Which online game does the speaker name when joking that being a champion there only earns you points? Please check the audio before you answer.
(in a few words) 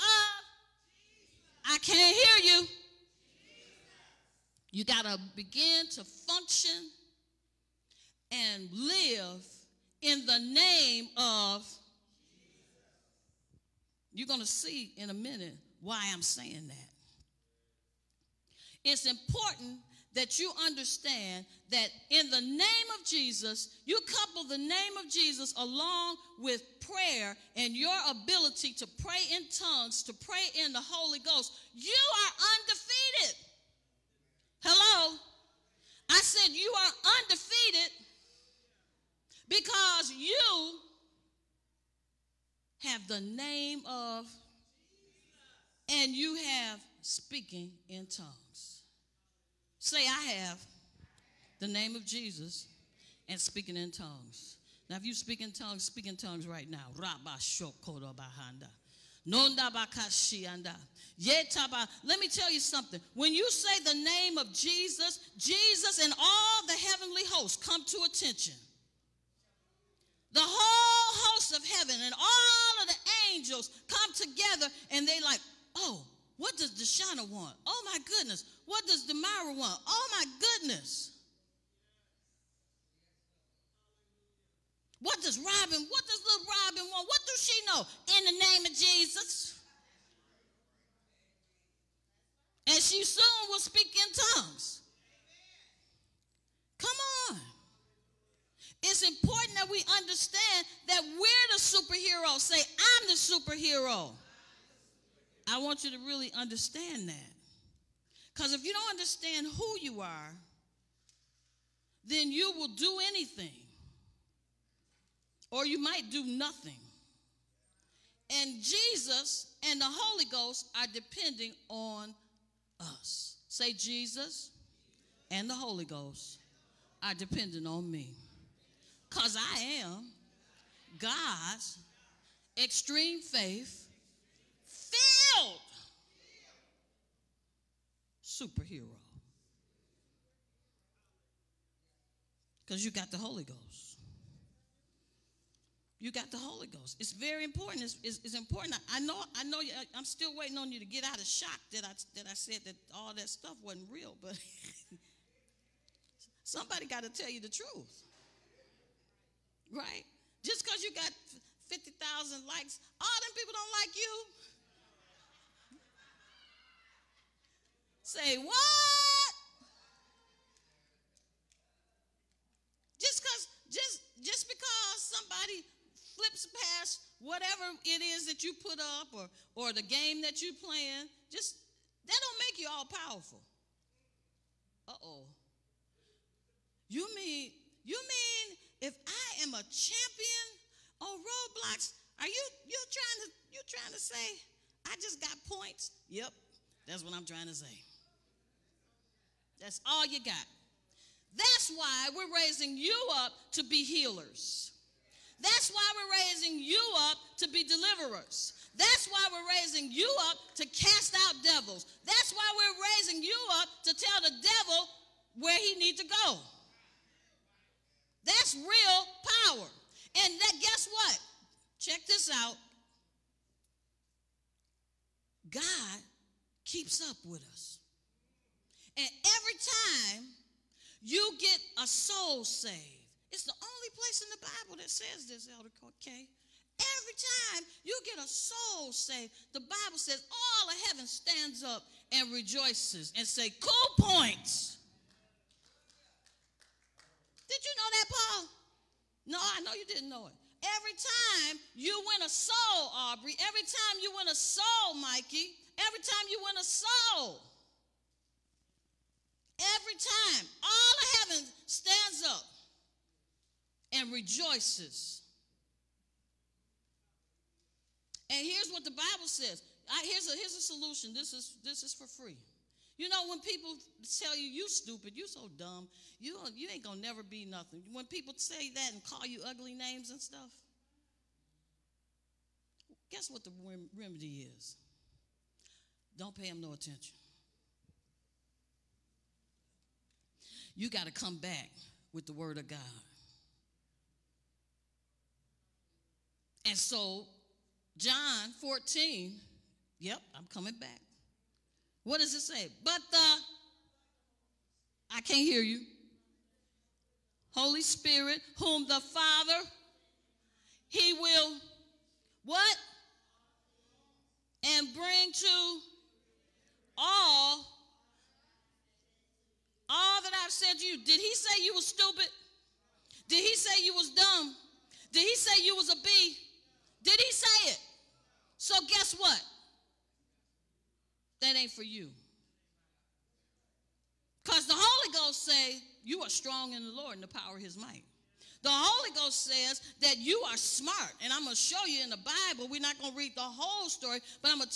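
Roblox.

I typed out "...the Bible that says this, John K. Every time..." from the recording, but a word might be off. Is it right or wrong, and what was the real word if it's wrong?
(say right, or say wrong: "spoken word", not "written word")
wrong: "Elder", not "John".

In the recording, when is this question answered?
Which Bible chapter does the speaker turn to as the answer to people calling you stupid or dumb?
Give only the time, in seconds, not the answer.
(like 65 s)
297 s.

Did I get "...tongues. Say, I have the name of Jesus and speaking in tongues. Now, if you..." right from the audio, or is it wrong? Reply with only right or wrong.
right.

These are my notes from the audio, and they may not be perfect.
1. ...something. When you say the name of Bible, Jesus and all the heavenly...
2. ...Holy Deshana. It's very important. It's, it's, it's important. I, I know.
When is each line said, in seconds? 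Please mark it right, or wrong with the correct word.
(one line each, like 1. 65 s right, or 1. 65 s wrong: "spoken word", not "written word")
1. 62 s wrong: "Jesus", not "Bible"
2. 146 s wrong: "Ghost", not "Deshana".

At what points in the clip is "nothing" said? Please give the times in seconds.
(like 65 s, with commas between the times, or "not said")
116 s, 277 s.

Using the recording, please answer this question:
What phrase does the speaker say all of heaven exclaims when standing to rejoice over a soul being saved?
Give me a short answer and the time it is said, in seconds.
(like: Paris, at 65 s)
Cool points, at 243 s.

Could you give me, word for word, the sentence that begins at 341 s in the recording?
And I'm going to show you in the Bible.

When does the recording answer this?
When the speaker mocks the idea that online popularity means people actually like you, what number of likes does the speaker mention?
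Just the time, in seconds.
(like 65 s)
161 s.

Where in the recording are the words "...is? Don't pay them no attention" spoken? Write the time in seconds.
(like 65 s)
284 s.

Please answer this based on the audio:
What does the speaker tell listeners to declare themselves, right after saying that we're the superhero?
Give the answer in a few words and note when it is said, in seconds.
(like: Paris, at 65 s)
I'm the superhero, at 102 s.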